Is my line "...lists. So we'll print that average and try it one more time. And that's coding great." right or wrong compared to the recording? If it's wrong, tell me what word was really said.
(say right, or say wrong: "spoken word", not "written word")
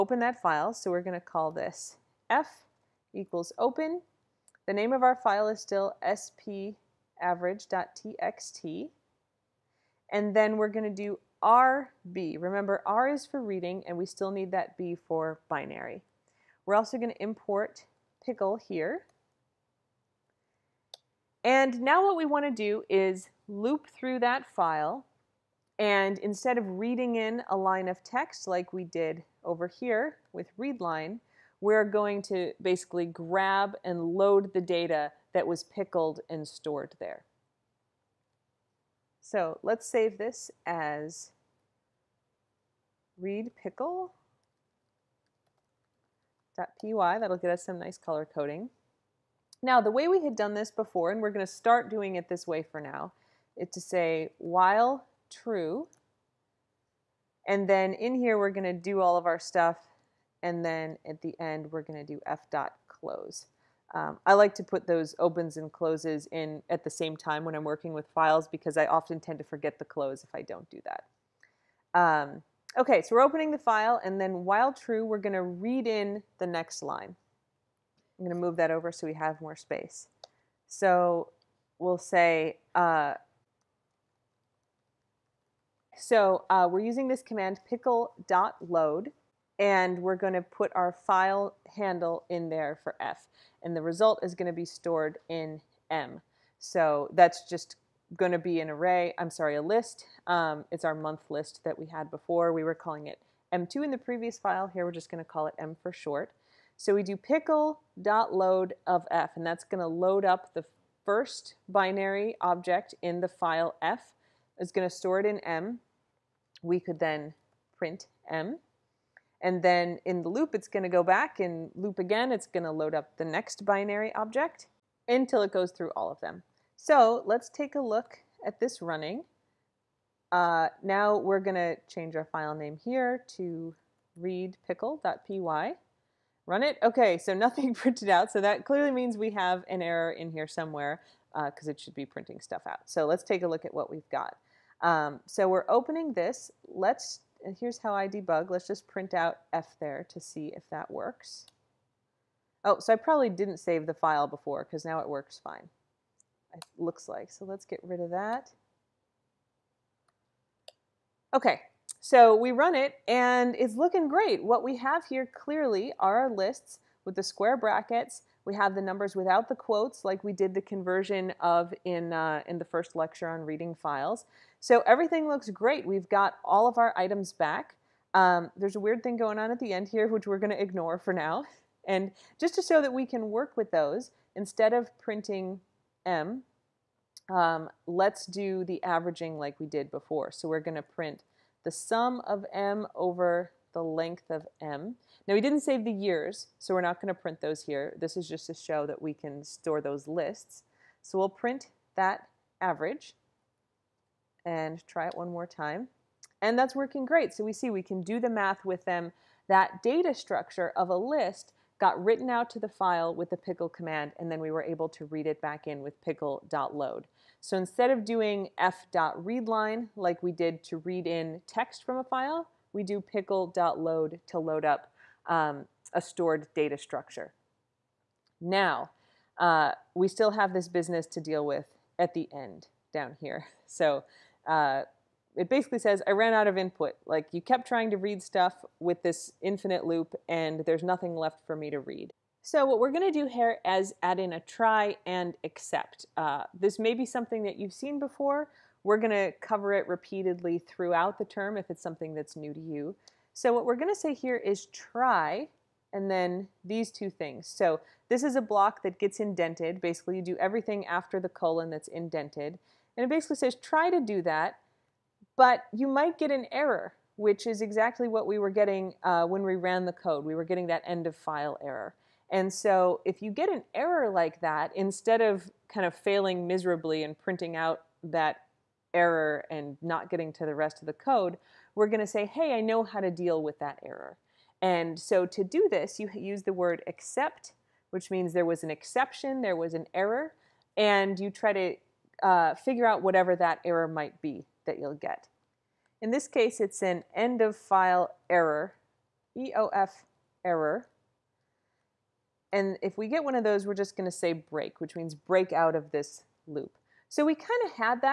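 wrong: "working", not "coding".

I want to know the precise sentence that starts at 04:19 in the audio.
Basically, you do everything after the colon that's indented.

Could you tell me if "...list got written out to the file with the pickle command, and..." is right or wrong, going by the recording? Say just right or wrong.
right.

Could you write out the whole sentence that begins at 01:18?
I'm going to move that over so we have more space.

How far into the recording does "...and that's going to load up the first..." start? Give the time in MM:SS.
01:49.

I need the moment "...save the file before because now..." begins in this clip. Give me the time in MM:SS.
02:33.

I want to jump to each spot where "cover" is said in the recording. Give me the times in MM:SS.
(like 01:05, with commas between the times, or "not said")
04:09.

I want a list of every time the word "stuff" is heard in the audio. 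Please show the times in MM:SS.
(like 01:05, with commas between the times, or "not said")
00:59, 02:22, 03:58.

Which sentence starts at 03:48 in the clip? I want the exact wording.
Now, uh, we still have this business to deal with at the end down here.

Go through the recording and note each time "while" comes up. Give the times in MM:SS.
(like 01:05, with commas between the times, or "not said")
00:54, 01:14.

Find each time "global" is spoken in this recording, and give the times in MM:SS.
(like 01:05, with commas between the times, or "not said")
not said.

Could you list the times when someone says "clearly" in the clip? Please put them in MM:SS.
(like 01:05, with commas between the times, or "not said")
02:18, 02:45.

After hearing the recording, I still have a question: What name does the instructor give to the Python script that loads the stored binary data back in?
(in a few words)
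read_pickle.py.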